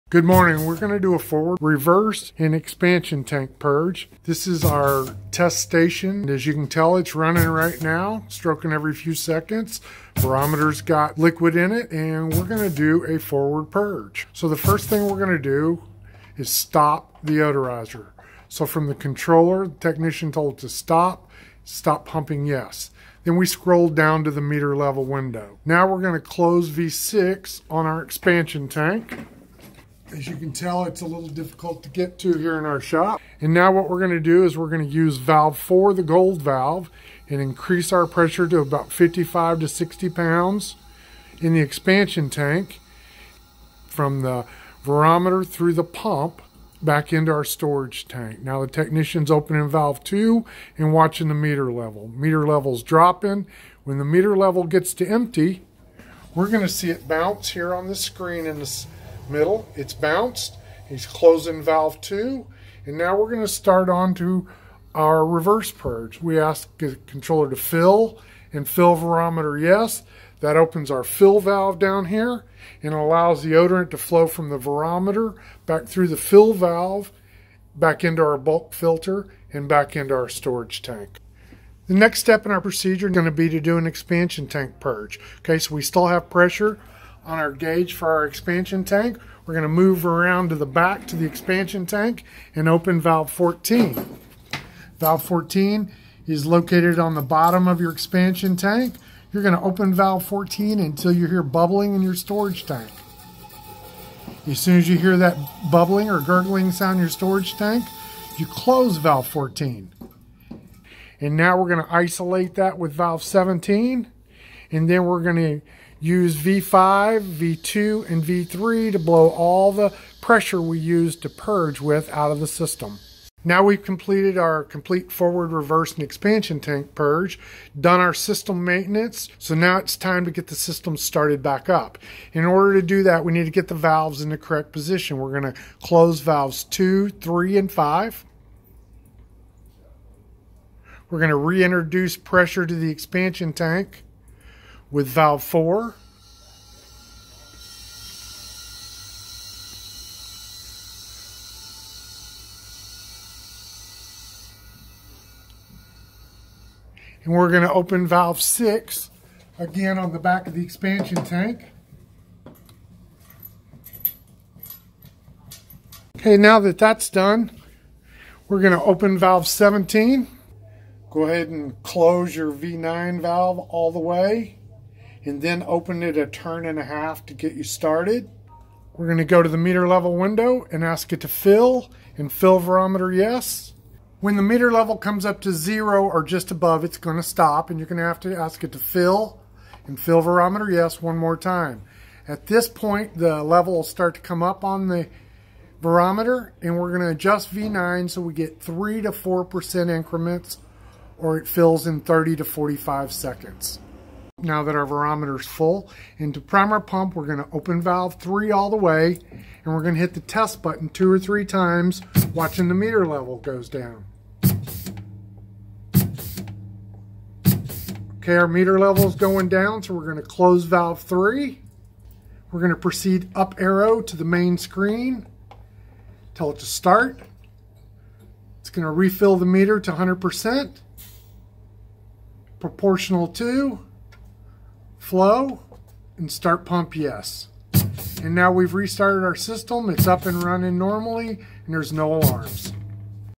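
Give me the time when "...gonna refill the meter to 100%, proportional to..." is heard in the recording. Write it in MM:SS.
03:48.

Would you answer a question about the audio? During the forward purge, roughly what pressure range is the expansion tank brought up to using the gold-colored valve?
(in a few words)
55 to 60 pounds.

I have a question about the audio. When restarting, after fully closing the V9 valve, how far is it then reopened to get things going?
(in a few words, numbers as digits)
A turn and a half.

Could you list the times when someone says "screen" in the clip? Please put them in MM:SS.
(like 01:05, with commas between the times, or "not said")
00:57, 03:44.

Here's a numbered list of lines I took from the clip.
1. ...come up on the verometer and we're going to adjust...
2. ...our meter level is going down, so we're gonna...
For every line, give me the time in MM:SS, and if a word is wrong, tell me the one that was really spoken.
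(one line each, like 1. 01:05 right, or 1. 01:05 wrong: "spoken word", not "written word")
1. 03:14 right
2. 03:38 right.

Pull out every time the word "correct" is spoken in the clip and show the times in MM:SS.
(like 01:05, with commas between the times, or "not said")
02:14.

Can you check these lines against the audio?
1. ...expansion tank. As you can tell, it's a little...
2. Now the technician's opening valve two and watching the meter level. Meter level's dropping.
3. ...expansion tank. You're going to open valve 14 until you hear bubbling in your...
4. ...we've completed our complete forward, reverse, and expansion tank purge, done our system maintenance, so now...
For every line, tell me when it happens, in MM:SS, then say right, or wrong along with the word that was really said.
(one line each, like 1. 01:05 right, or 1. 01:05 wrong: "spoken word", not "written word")
1. 00:28 right
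2. 00:48 right
3. 01:37 right
4. 02:03 right.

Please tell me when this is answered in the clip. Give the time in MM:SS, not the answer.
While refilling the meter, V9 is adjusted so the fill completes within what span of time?
03:22.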